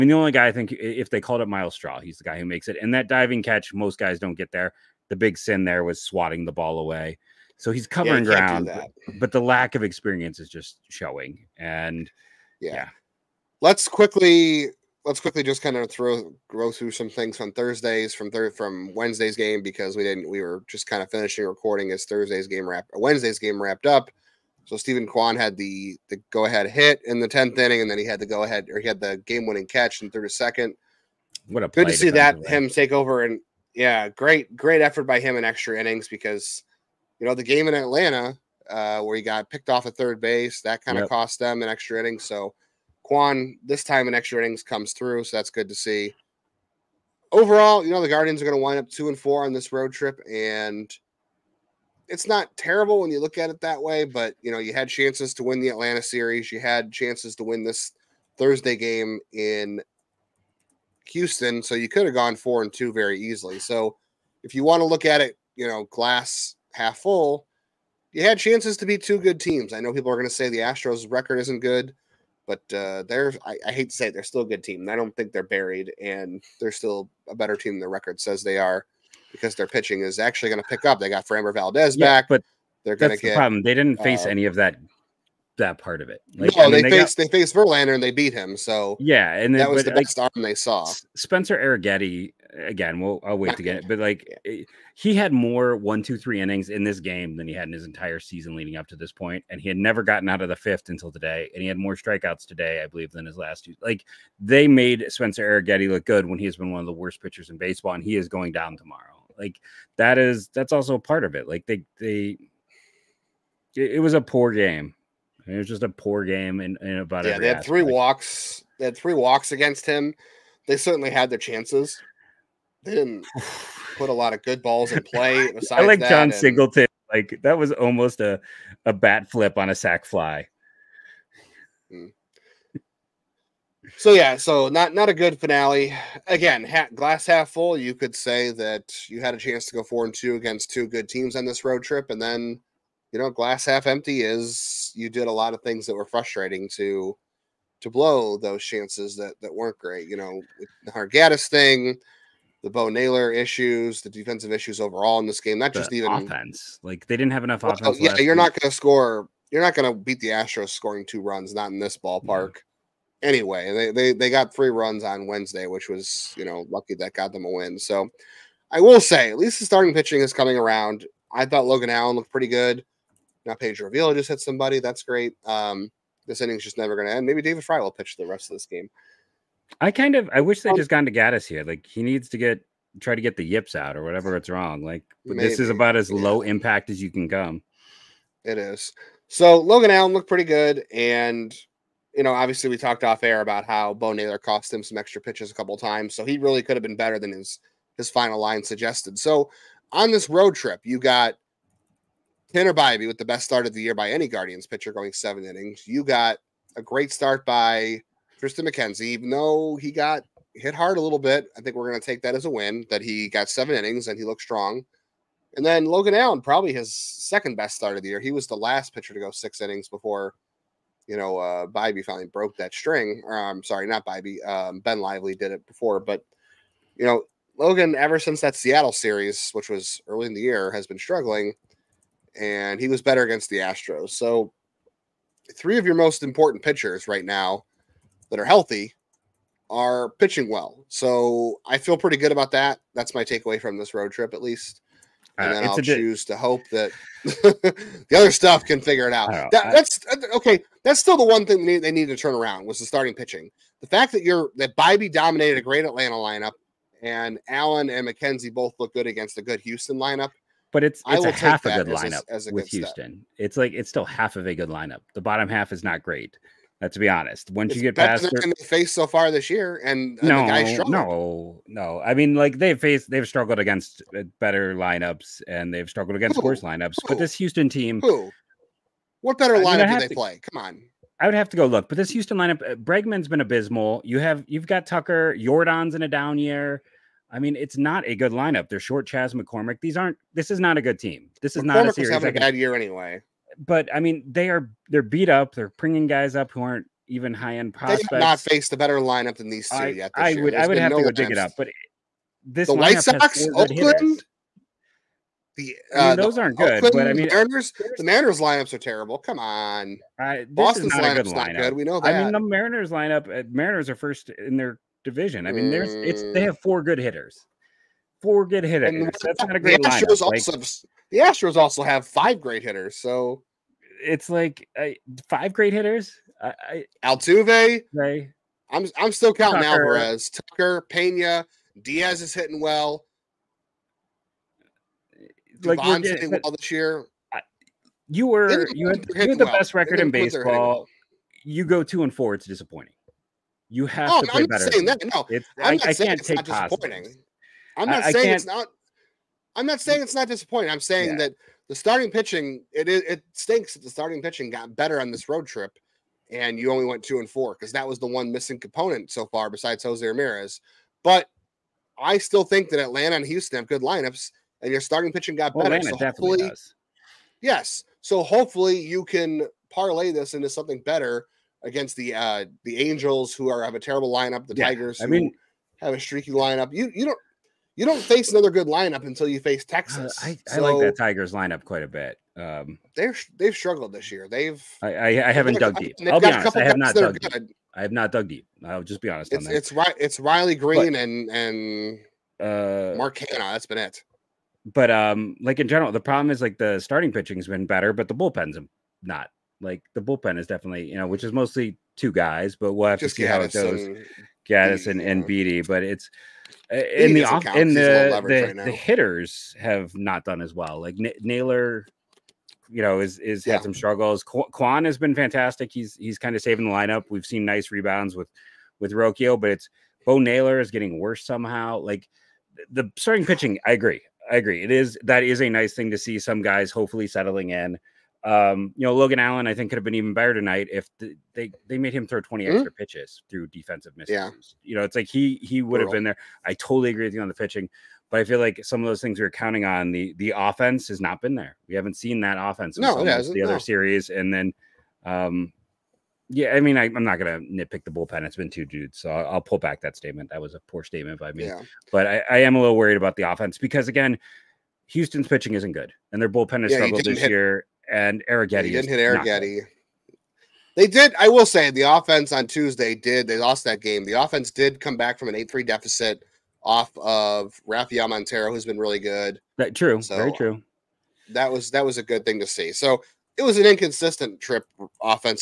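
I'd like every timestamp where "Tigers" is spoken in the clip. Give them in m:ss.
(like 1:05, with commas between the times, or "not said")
6:14, 6:20.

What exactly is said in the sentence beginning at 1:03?
So if you want to look at it, you know, glass half full, you had chances to be two good teams.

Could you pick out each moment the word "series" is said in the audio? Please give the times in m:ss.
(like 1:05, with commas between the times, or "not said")
0:56, 3:48, 4:51, 7:23.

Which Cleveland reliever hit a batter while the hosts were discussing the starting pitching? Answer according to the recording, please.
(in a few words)
Pedro Avila.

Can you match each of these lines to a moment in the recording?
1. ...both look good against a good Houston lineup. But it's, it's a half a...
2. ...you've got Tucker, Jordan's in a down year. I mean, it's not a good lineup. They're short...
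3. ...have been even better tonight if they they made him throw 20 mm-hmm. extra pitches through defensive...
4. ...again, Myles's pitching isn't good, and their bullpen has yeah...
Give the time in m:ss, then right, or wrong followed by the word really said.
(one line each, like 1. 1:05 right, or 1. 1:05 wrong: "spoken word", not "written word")
1. 4:18 right
2. 4:44 right
3. 7:09 right
4. 7:33 wrong: "Houston", not "Myles".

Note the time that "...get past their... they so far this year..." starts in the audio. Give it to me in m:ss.
4:27.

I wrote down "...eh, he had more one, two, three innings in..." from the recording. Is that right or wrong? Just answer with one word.
right.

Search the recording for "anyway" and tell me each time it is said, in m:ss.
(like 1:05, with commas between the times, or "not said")
2:43, 4:52.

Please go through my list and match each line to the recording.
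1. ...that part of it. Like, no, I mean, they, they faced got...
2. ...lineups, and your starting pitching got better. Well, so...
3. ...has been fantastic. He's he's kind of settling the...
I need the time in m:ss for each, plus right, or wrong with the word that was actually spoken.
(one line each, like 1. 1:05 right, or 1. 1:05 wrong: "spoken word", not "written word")
1. 1:25 right
2. 6:03 right
3. 6:54 wrong: "saving", not "settling".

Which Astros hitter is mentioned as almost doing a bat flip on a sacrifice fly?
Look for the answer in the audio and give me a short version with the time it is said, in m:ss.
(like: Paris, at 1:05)
Jon Singleton, at 2:06.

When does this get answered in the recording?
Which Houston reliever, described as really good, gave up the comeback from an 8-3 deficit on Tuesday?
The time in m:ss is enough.
7:47.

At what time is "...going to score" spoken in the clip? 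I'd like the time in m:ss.
2:38.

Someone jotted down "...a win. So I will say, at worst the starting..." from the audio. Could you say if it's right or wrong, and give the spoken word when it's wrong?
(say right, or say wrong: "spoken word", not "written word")
wrong: "least", not "worst".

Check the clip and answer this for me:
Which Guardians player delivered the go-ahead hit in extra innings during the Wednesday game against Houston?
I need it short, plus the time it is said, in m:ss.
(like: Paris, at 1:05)
Steven Kwan, at 0:24.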